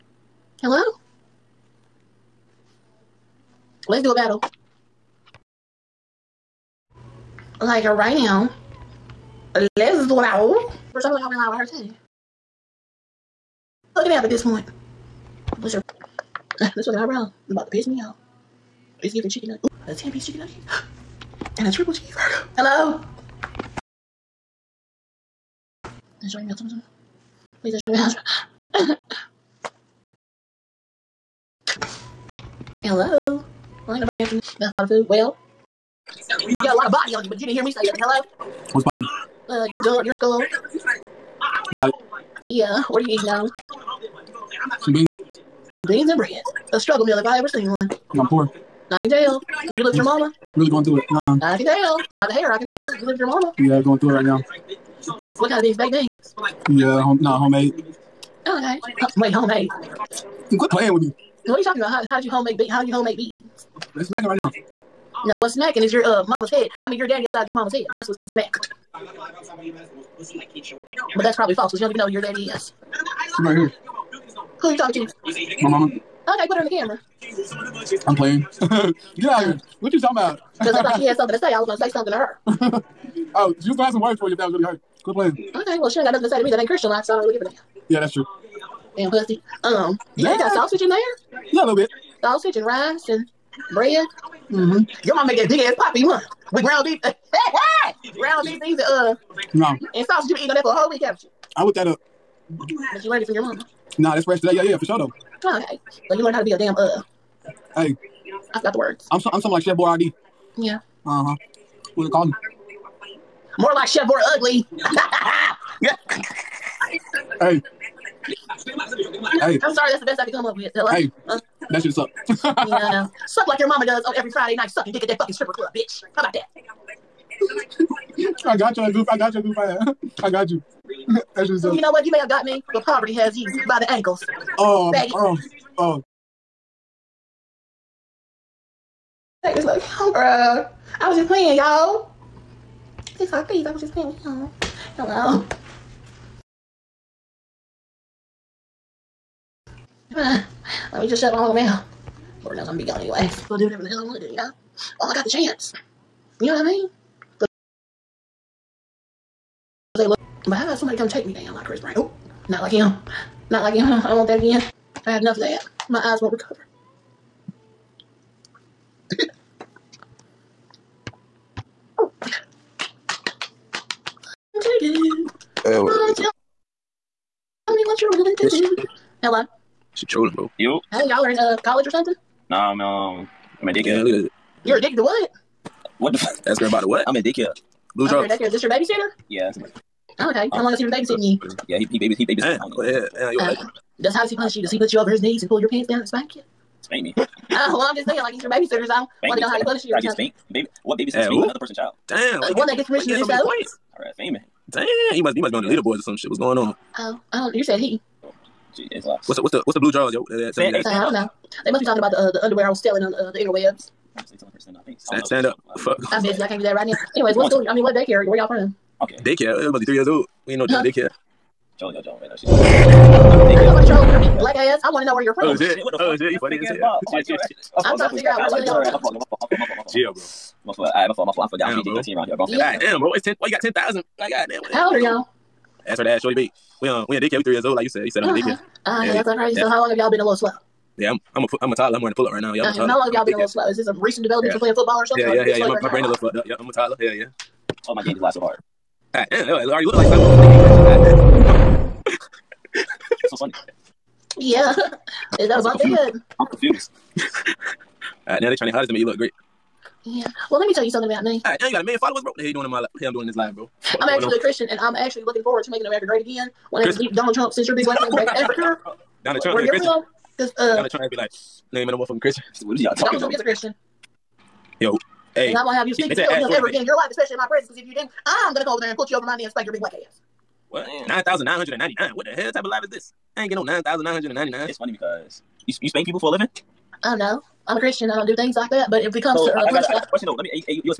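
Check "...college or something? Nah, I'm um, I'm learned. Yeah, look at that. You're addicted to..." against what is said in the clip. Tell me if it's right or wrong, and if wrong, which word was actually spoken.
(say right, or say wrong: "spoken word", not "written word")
wrong: "addicted", not "learned".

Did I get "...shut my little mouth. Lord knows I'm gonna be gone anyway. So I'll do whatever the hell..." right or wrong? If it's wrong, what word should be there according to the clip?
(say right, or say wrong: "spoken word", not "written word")
right.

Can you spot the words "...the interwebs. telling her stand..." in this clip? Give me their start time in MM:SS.
03:33.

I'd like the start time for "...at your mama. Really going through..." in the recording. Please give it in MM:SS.
00:49.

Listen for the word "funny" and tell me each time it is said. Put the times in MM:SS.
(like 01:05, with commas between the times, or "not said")
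03:46, 04:13, 04:44.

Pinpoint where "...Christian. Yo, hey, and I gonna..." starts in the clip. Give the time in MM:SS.
04:33.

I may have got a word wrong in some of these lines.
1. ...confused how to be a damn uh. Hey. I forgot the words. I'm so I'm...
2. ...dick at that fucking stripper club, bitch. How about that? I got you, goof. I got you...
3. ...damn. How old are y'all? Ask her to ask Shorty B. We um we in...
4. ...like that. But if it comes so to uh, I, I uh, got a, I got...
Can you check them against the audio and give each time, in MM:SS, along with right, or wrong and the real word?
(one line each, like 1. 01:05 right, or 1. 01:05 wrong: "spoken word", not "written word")
1. 01:46 wrong: "learned", not "confused"
2. 02:04 right
3. 03:54 right
4. 04:48 right.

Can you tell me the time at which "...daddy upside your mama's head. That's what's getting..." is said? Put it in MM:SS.
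01:07.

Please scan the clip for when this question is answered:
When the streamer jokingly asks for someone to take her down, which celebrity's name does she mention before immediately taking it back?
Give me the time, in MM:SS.
02:41.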